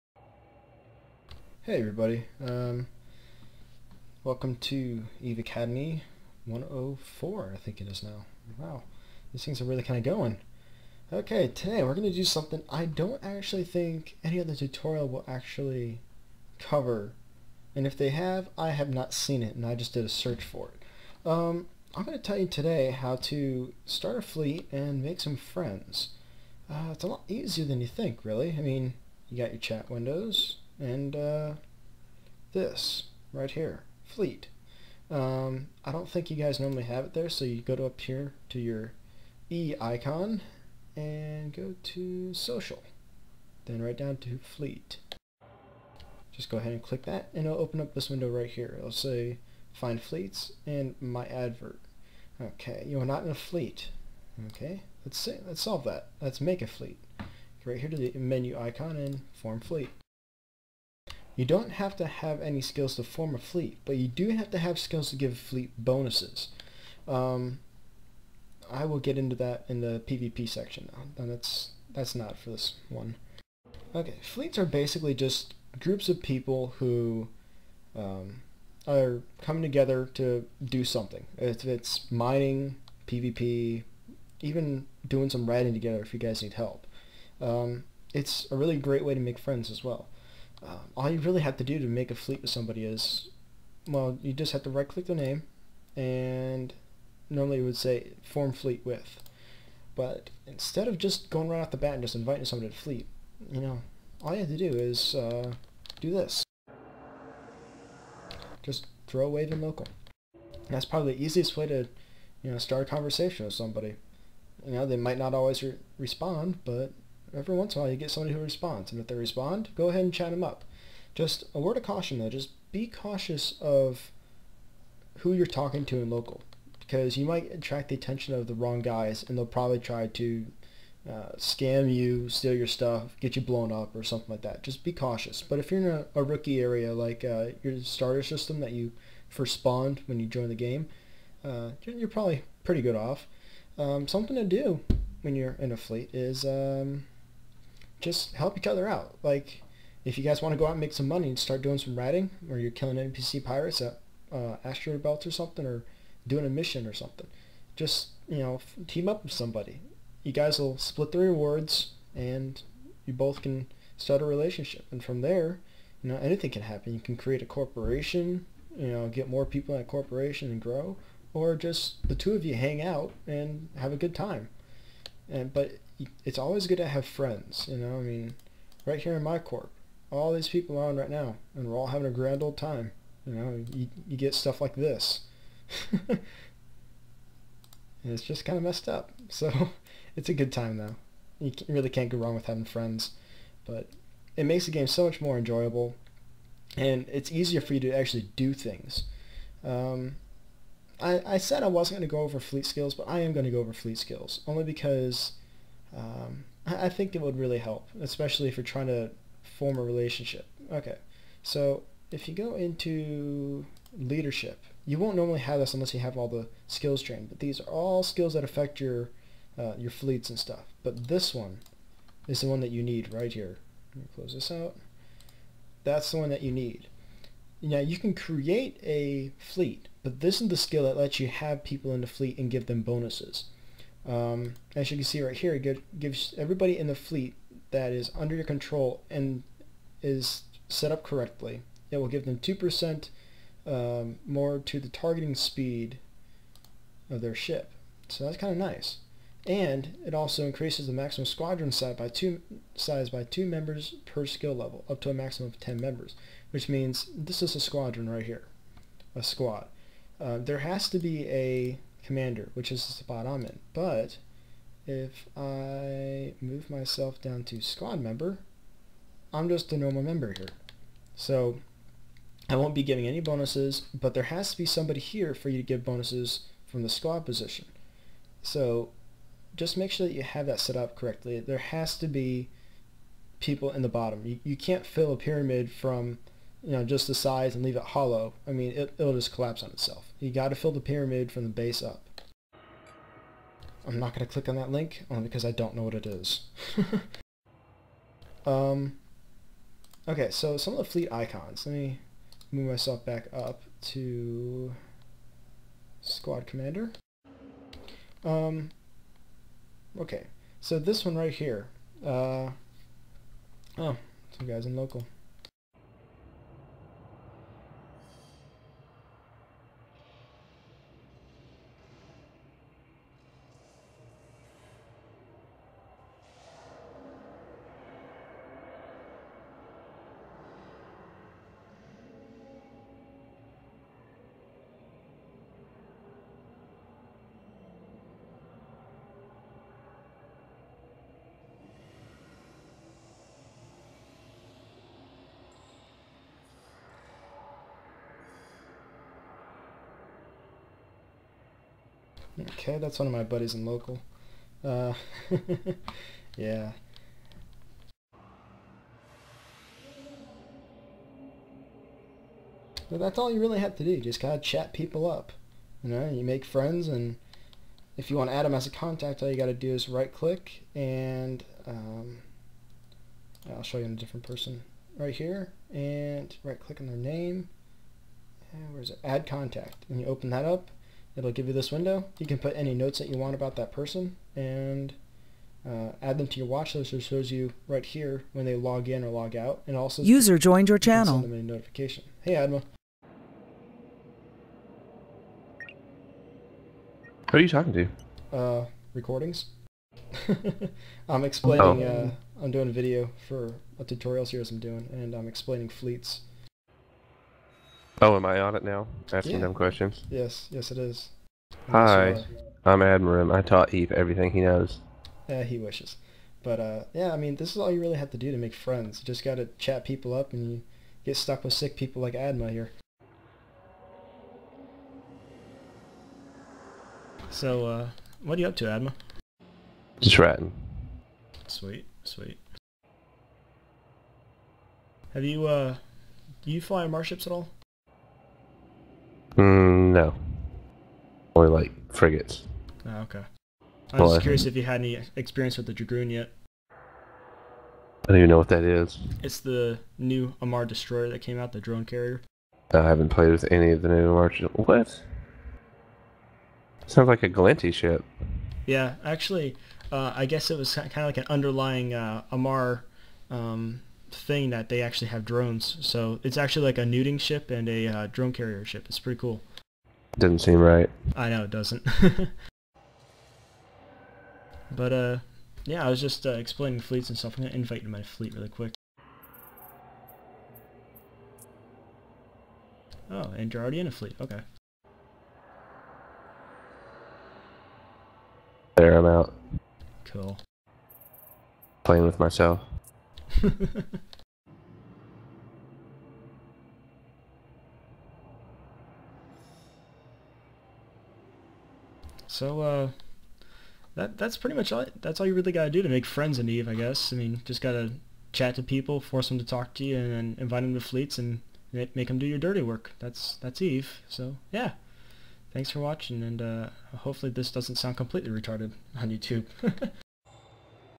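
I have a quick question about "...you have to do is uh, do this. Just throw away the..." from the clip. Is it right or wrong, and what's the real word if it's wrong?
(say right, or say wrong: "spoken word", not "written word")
right.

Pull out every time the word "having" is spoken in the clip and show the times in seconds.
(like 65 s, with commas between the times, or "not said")
181 s, 192 s.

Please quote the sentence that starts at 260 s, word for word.
Uh, there has to be a commander, which is the spot I'm in.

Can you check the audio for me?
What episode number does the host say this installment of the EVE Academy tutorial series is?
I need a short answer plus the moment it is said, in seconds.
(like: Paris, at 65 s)
104, at 6 s.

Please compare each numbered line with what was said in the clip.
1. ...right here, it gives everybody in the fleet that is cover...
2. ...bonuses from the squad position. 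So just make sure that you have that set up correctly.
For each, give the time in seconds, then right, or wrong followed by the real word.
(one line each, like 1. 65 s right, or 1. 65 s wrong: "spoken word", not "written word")
1. 235 s wrong: "under", not "cover"
2. 275 s right.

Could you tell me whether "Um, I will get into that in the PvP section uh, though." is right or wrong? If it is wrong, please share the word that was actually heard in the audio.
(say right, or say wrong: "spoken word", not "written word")
right.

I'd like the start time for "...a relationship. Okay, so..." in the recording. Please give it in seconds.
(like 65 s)
209 s.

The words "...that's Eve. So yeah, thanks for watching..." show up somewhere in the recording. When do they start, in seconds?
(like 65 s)
513 s.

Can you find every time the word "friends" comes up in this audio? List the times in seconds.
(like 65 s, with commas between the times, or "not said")
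25 s, 89 s, 177 s, 192 s, 366 s, 418 s, 506 s.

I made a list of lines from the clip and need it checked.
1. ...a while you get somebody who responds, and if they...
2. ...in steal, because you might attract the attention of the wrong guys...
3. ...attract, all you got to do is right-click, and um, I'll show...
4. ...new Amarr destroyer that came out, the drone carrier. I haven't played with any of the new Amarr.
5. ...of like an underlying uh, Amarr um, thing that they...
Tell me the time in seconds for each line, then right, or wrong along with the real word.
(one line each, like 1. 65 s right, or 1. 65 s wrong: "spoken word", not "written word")
1. 117 s right
2. 126 s wrong: "local", not "steal"
3. 368 s wrong: "contact", not "attract"
4. 449 s right
5. 460 s right.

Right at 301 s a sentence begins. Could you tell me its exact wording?
Let me move myself back up to squad commander.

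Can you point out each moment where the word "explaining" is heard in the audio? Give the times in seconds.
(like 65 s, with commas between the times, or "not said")
401 s, 405 s, 476 s.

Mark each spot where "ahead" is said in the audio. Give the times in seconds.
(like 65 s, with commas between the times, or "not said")
46 s, 119 s.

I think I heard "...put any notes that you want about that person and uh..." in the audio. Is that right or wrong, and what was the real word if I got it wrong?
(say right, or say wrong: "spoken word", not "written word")
right.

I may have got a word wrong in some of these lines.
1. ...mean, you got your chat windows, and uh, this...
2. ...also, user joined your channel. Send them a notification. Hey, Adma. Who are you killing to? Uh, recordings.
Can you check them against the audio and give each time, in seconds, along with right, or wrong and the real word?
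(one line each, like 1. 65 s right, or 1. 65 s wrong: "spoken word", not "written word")
1. 28 s right
2. 389 s wrong: "talking", not "killing".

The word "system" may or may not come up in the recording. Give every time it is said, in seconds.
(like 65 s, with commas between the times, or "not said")
138 s.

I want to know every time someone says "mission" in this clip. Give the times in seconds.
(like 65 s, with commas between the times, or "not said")
156 s.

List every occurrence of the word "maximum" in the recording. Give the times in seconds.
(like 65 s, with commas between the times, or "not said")
250 s, 255 s.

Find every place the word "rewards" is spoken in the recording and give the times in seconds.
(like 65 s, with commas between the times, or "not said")
161 s.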